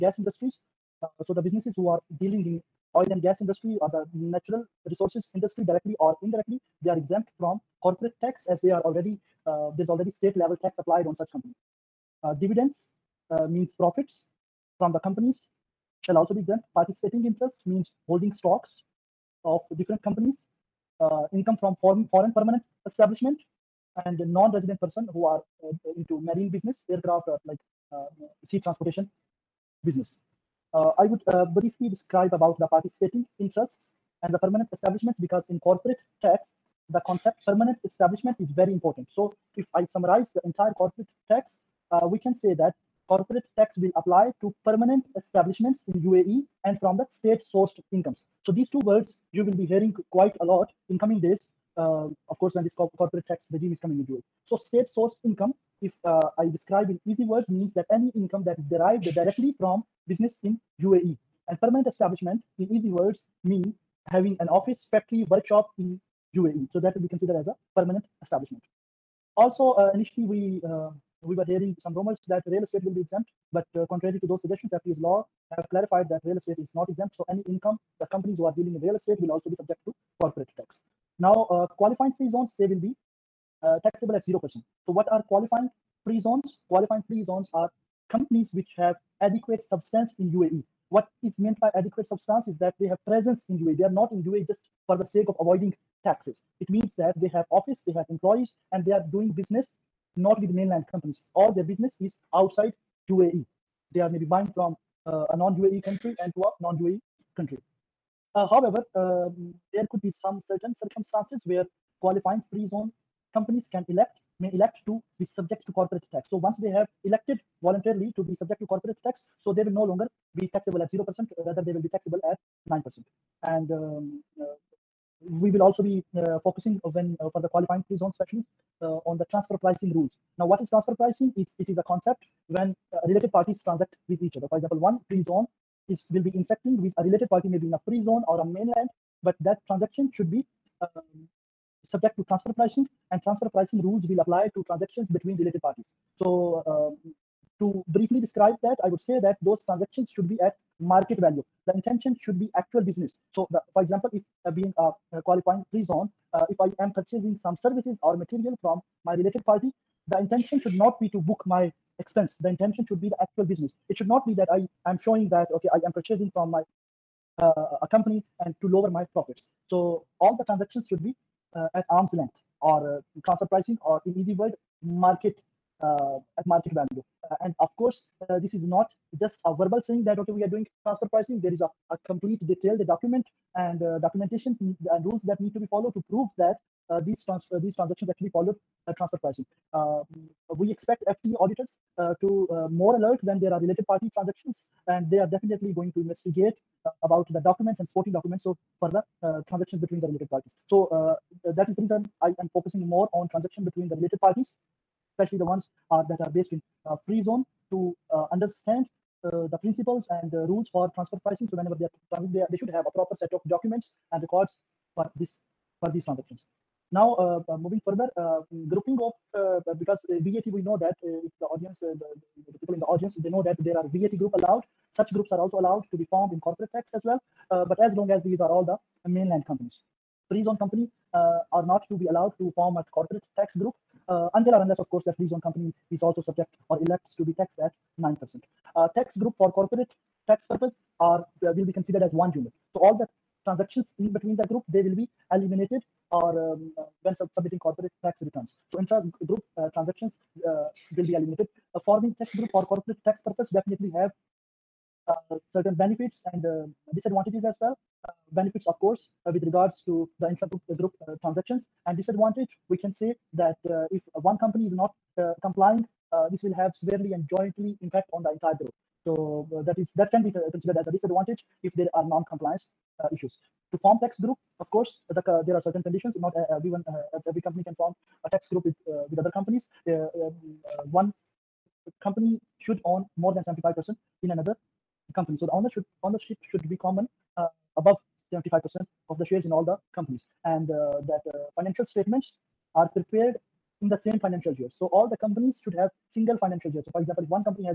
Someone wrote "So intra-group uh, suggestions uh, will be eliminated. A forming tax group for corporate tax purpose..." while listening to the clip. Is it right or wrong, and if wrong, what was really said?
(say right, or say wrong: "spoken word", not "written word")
wrong: "transactions", not "suggestions".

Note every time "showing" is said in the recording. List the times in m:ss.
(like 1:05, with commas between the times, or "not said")
2:45.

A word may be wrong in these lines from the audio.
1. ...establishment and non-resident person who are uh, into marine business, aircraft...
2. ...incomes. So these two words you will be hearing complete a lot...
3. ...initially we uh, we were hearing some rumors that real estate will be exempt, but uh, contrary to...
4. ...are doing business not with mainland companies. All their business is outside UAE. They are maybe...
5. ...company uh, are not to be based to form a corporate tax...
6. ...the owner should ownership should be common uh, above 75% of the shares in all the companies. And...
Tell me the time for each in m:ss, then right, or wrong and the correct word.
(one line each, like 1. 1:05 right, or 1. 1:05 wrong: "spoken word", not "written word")
1. 0:22 right
2. 0:47 wrong: "quite", not "complete"
3. 1:09 right
4. 1:38 right
5. 3:50 wrong: "allowed", not "based"
6. 4:45 right.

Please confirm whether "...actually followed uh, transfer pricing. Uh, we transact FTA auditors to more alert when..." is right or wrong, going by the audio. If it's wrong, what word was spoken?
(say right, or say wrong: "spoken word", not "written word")
wrong: "expect", not "transact".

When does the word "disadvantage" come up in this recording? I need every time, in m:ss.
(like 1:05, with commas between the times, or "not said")
4:16, 4:21, 4:30.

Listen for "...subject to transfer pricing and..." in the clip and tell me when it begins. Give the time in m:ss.
2:21.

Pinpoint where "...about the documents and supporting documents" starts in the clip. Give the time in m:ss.
3:17.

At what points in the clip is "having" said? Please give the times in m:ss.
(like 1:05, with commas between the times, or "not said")
1:04.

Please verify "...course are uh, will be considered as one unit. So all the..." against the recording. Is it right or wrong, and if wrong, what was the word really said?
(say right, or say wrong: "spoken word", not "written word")
wrong: "purpose", not "course".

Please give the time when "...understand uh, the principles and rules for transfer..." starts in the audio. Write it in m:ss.
3:28.